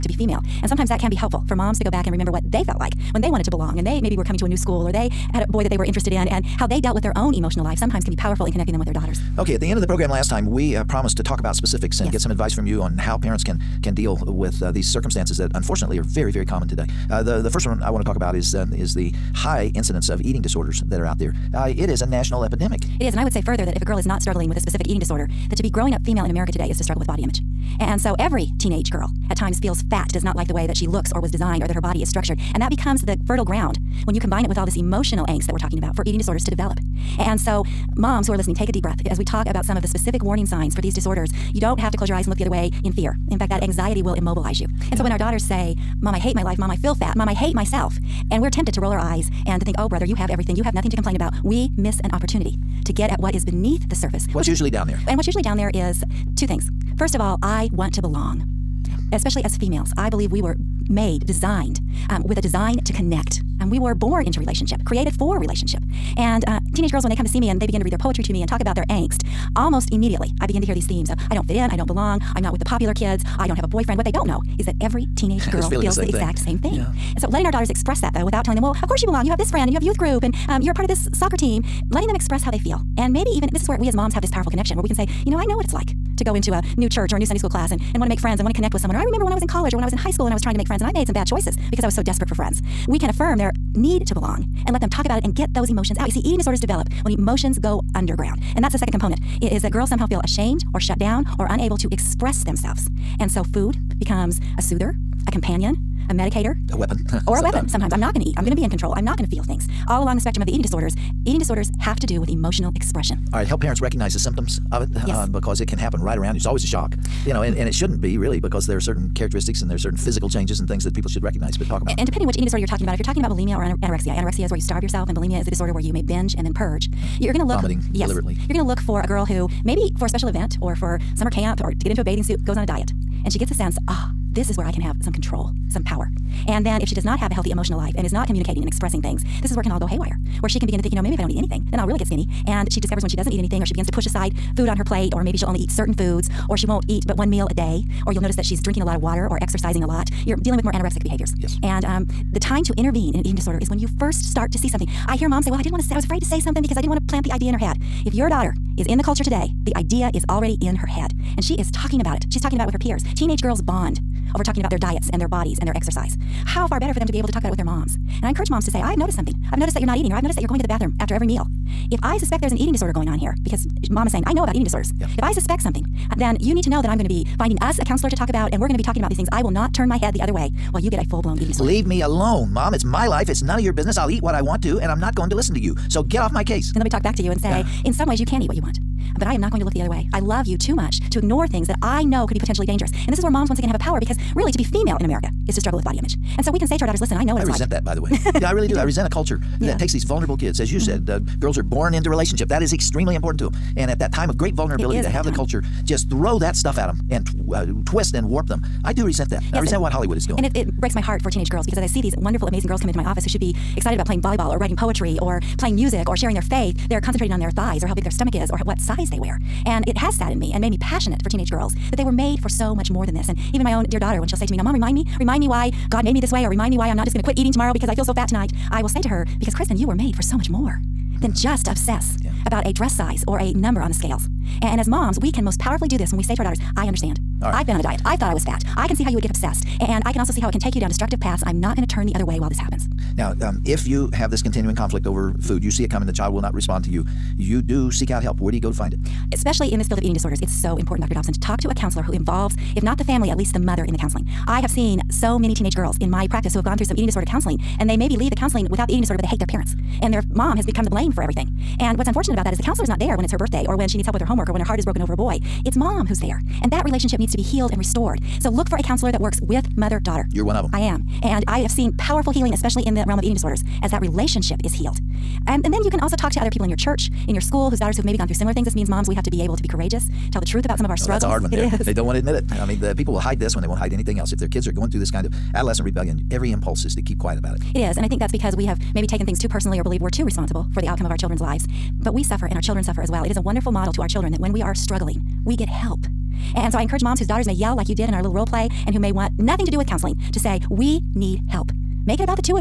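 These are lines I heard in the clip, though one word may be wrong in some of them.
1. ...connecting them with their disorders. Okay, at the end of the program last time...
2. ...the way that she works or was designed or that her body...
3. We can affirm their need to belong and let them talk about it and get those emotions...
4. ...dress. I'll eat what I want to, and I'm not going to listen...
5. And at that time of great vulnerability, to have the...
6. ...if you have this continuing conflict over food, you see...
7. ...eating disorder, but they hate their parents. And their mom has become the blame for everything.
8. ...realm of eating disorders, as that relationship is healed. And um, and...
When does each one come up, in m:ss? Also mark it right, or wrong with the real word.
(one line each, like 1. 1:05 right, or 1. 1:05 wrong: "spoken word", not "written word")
1. 0:08 wrong: "daughters", not "disorders"
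2. 0:30 wrong: "looks", not "works"
3. 1:32 right
4. 3:03 wrong: "business", not "dress"
5. 3:23 right
6. 4:03 right
7. 4:18 right
8. 4:33 right.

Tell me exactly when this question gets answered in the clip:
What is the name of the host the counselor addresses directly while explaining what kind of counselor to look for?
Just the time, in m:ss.
4:11.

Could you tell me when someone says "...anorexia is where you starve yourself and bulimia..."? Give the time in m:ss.
2:04.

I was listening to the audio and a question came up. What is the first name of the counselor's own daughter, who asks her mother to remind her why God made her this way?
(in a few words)
Kristen.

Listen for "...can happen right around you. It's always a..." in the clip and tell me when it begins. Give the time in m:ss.
1:55.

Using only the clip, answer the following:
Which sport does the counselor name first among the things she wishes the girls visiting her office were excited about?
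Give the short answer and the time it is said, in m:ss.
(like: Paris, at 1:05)
volleyball, at 3:34.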